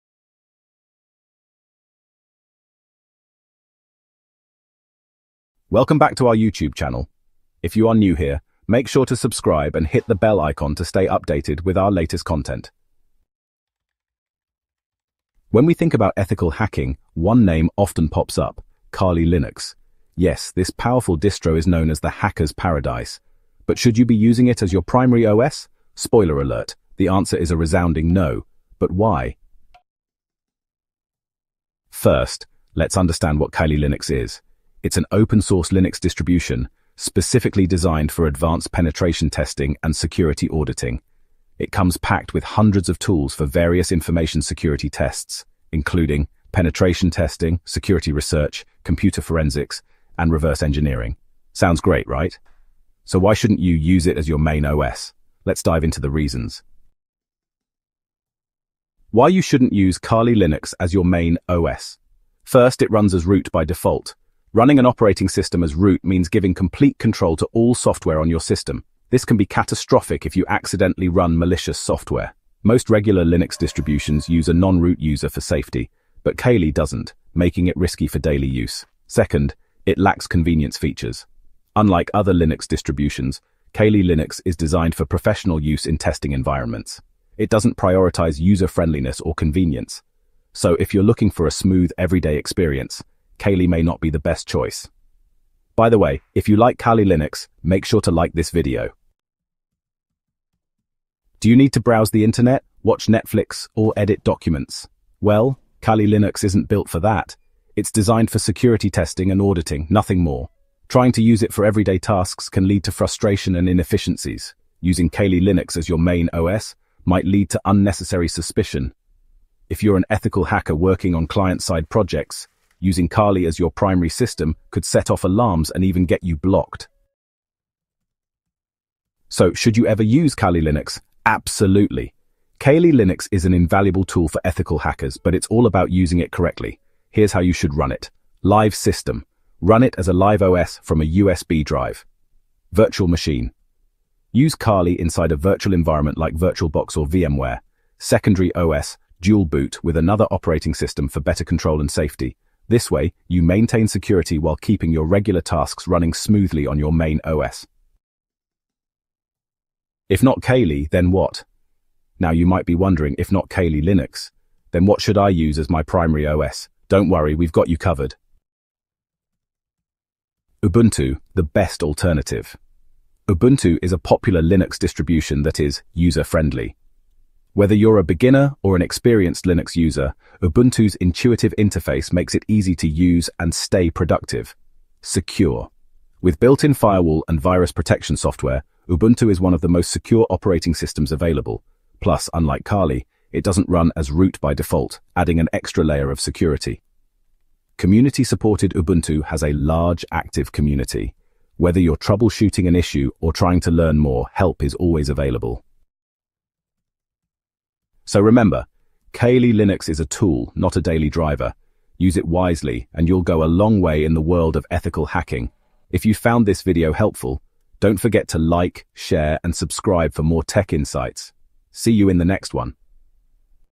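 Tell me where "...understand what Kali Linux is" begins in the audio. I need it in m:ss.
0:32.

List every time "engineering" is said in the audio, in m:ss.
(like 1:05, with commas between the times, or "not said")
0:50.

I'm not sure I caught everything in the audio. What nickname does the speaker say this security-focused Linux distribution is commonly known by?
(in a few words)
The hacker's paradise.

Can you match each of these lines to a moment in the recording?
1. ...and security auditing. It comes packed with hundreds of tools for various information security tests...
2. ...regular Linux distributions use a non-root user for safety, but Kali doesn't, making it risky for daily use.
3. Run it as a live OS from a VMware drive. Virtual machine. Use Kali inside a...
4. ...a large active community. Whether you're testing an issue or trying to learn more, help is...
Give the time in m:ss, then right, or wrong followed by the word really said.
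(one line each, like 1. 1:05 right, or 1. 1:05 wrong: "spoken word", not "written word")
1. 0:39 right
2. 1:12 right
3. 2:19 wrong: "USB", not "VMware"
4. 3:19 wrong: "troubleshooting", not "testing".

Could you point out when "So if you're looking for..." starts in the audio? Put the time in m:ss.
1:30.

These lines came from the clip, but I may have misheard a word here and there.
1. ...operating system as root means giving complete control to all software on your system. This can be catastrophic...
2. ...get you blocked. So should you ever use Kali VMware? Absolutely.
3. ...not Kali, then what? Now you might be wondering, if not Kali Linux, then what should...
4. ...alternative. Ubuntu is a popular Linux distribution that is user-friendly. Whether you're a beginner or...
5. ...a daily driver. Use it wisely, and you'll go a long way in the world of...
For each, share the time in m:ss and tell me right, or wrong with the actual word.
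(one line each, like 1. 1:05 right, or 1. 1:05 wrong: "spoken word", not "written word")
1. 1:04 right
2. 2:06 wrong: "Linux", not "VMware"
3. 2:40 right
4. 2:51 right
5. 3:30 right.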